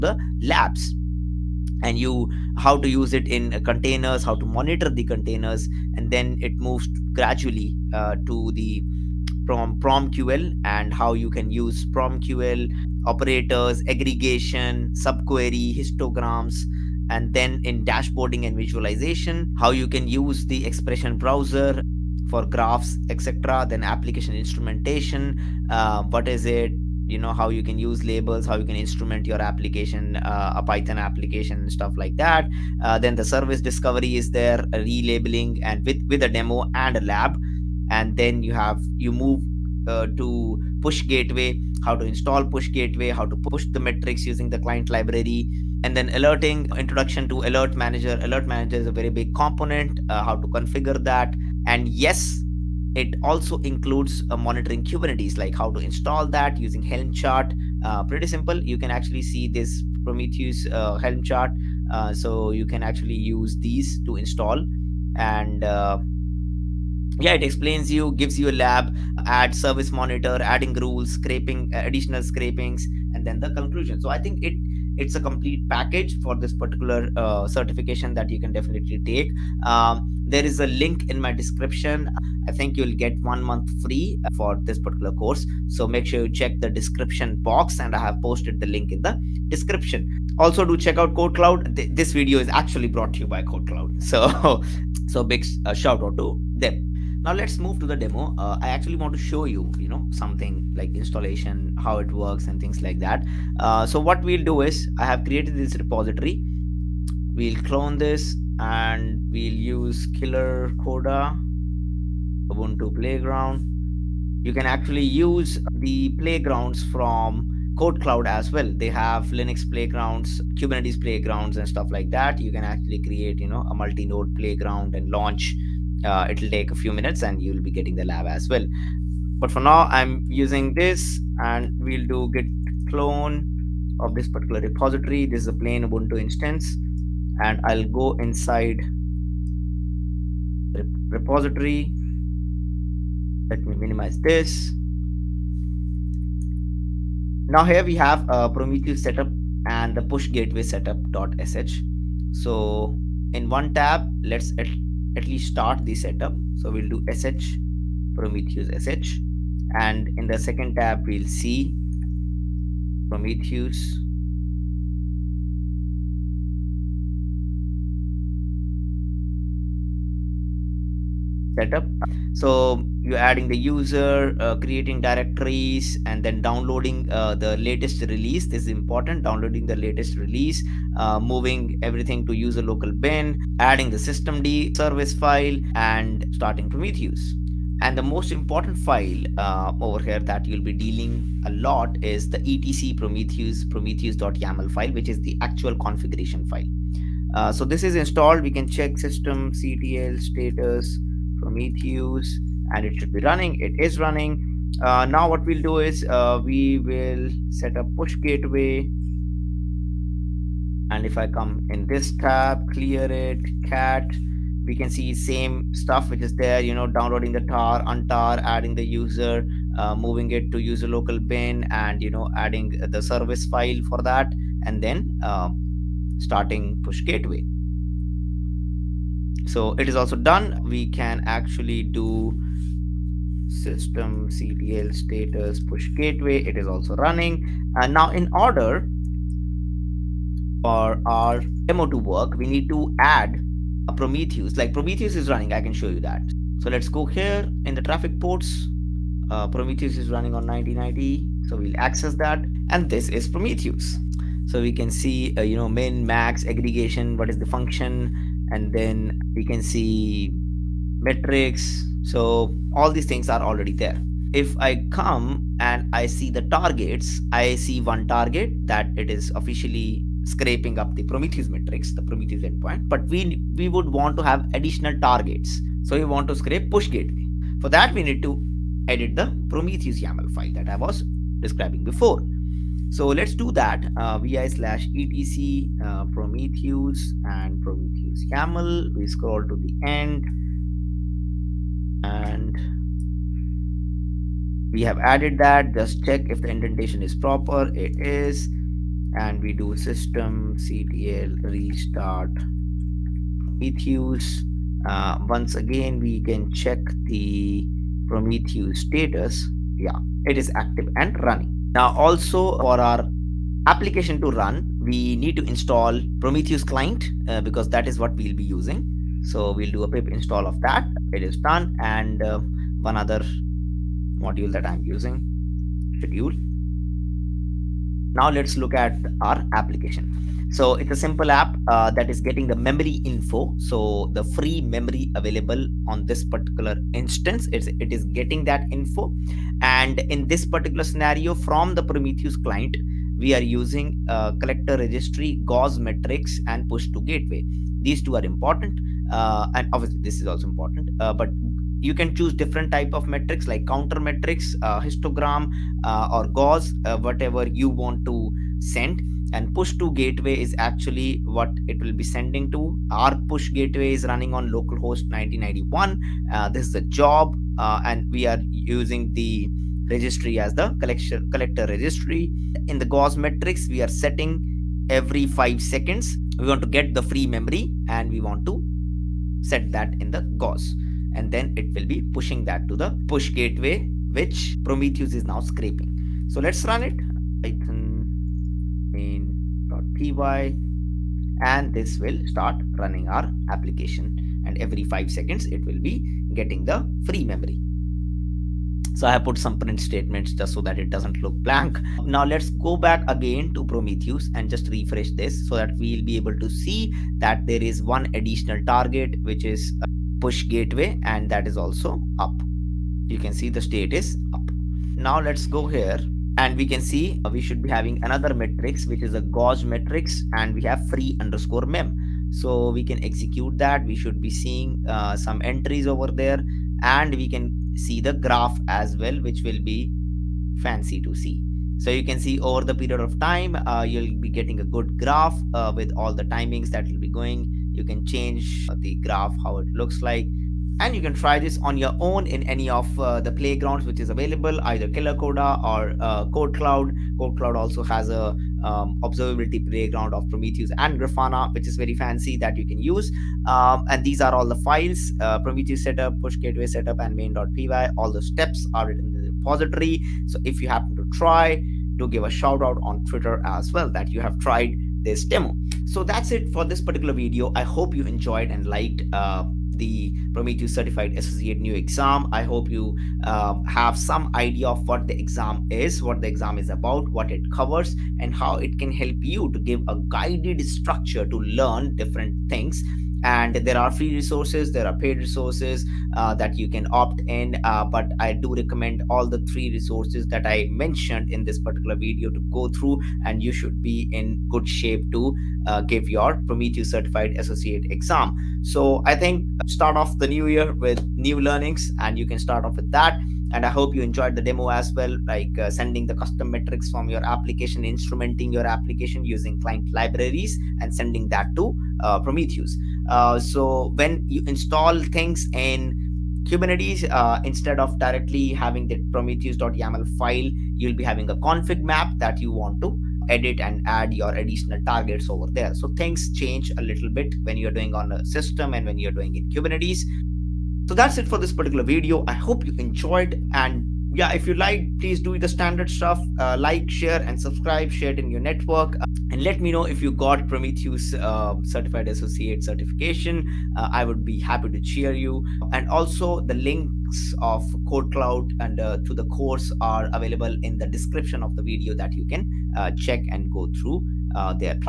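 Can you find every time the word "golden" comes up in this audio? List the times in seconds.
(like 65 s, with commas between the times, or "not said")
not said.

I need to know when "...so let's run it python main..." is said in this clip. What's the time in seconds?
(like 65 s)
386 s.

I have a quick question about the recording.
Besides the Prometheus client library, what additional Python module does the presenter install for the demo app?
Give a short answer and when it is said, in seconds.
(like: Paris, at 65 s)
schedule, at 325 s.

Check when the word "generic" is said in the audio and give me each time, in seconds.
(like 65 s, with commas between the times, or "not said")
not said.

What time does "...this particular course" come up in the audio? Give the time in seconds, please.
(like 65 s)
84 s.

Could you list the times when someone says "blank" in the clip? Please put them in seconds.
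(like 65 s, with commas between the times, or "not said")
401 s.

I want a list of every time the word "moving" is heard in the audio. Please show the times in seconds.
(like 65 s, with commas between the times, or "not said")
181 s, 219 s.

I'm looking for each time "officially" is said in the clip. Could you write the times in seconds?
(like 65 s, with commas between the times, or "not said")
269 s.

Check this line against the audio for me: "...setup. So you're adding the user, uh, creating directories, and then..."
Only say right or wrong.
right.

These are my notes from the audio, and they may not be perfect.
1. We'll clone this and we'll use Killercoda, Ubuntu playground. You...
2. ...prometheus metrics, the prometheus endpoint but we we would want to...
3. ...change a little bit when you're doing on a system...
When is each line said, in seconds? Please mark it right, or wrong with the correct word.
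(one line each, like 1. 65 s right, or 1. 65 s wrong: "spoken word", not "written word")
1. 107 s right
2. 271 s right
3. 526 s right.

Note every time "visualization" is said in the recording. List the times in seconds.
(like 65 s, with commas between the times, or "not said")
18 s.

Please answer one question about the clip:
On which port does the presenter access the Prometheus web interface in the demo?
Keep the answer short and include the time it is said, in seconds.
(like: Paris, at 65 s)
1990, at 250 s.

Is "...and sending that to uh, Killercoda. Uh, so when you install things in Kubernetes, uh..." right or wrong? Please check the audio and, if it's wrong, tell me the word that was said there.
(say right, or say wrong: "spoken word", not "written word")
wrong: "Prometheus", not "Killercoda".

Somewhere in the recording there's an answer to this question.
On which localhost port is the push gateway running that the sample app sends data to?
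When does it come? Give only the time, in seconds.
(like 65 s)
365 s.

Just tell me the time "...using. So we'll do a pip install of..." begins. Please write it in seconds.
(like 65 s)
318 s.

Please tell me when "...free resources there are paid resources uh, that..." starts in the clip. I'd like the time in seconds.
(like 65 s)
483 s.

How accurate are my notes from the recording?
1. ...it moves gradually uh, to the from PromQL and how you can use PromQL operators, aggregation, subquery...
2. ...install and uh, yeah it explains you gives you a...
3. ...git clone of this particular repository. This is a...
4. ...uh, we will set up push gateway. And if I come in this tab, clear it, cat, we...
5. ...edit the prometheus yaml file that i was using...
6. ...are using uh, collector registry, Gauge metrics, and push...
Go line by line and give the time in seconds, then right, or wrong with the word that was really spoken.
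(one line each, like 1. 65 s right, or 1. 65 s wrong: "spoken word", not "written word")
1. 6 s right
2. 64 s right
3. 132 s right
4. 206 s right
5. 278 s wrong: "describing", not "using"
6. 343 s right.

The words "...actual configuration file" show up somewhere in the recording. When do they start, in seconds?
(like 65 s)
195 s.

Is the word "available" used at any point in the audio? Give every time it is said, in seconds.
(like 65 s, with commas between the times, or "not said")
335 s, 444 s, 550 s.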